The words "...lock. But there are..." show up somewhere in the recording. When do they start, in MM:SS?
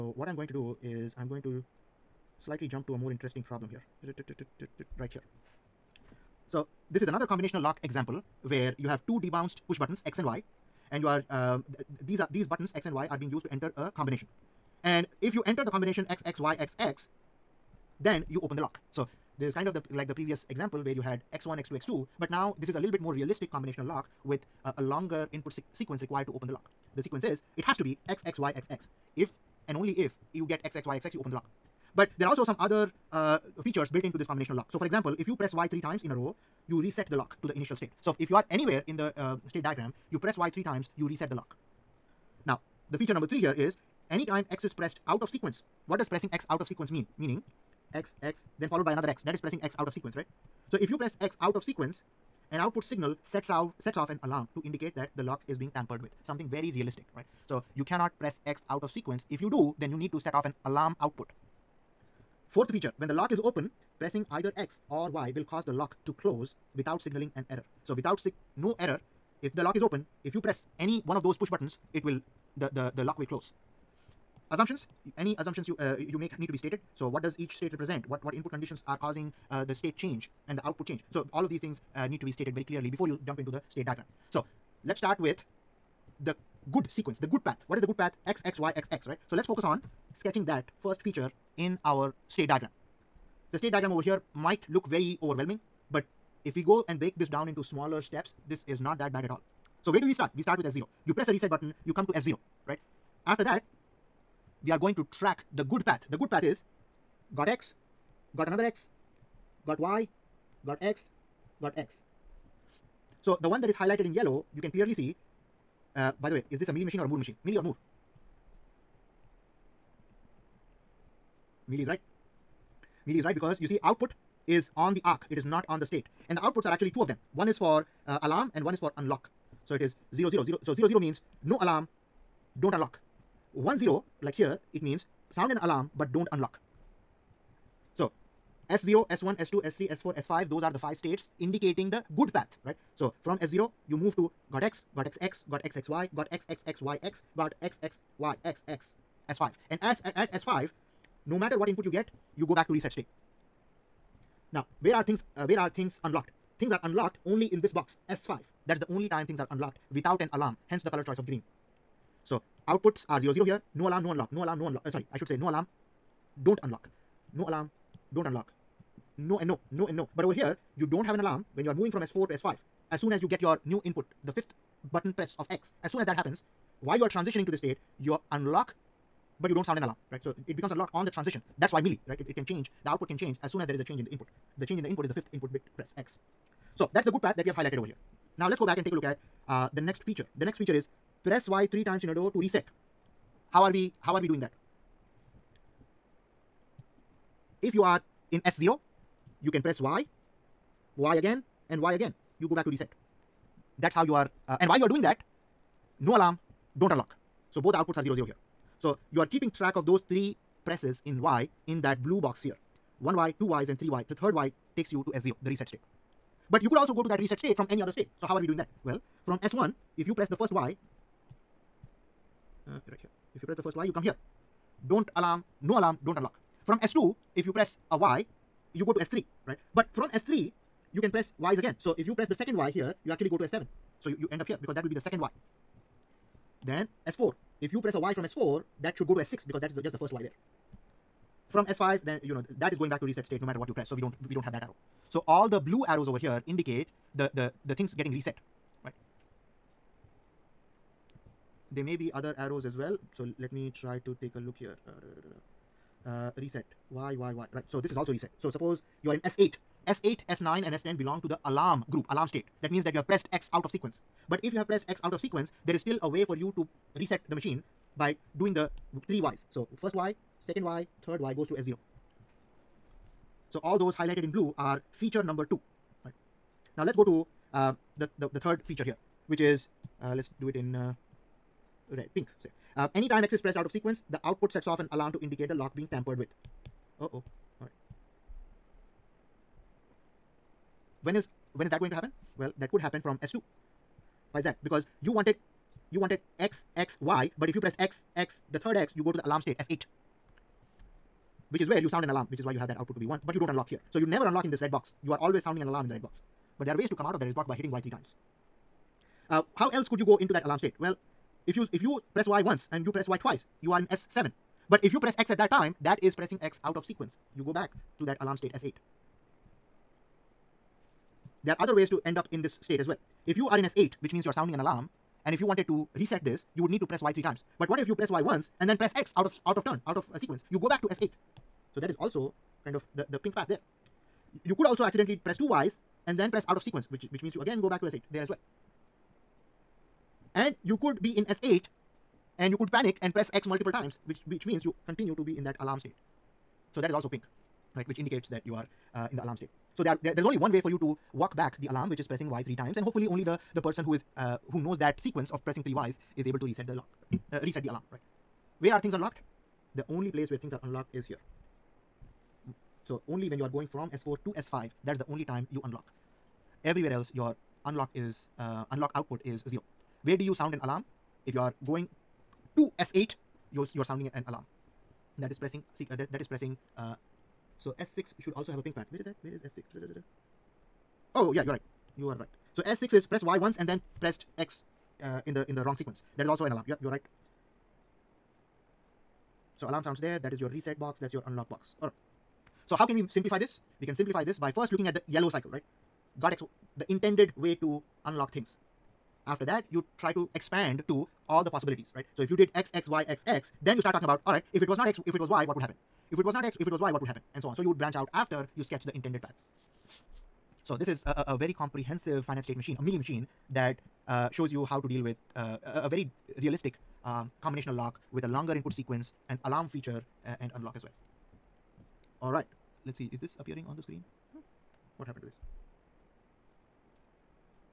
00:31.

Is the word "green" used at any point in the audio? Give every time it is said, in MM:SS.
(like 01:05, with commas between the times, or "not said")
02:41.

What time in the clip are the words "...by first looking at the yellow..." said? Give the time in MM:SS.
06:34.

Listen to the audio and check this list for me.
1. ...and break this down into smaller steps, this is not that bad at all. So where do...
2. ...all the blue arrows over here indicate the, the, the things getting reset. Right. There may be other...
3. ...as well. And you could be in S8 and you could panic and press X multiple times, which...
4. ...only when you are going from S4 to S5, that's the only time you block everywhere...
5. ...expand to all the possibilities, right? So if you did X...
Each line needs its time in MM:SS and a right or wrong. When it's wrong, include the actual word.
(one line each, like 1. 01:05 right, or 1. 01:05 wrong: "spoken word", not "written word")
1. 01:36 right
2. 04:05 right
3. 05:38 right
4. 06:03 wrong: "unlock", not "block"
5. 06:40 right.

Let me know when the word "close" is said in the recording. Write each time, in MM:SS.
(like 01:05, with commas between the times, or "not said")
01:06, 01:13.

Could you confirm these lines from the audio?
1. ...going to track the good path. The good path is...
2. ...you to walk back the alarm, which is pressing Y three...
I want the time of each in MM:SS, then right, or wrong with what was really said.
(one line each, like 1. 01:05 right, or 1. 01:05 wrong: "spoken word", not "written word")
1. 01:44 right
2. 05:50 right.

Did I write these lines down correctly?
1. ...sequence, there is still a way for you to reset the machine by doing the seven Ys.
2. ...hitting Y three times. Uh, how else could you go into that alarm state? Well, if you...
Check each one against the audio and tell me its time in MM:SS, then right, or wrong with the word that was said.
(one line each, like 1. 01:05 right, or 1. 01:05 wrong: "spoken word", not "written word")
1. 04:25 wrong: "three", not "seven"
2. 05:07 right.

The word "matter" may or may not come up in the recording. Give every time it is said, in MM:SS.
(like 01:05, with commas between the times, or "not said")
02:31, 04:03.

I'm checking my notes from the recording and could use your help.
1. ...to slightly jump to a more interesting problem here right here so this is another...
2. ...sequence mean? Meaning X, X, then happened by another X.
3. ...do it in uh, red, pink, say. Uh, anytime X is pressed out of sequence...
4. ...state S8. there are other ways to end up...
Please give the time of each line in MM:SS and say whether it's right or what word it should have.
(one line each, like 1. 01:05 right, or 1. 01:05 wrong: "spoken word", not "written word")
1. 00:01 right
2. 00:46 wrong: "followed", not "happened"
3. 04:40 right
4. 05:18 right.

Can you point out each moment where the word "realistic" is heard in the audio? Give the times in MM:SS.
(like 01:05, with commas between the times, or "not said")
00:23, 00:56, 06:56.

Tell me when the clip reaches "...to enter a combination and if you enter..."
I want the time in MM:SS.
00:13.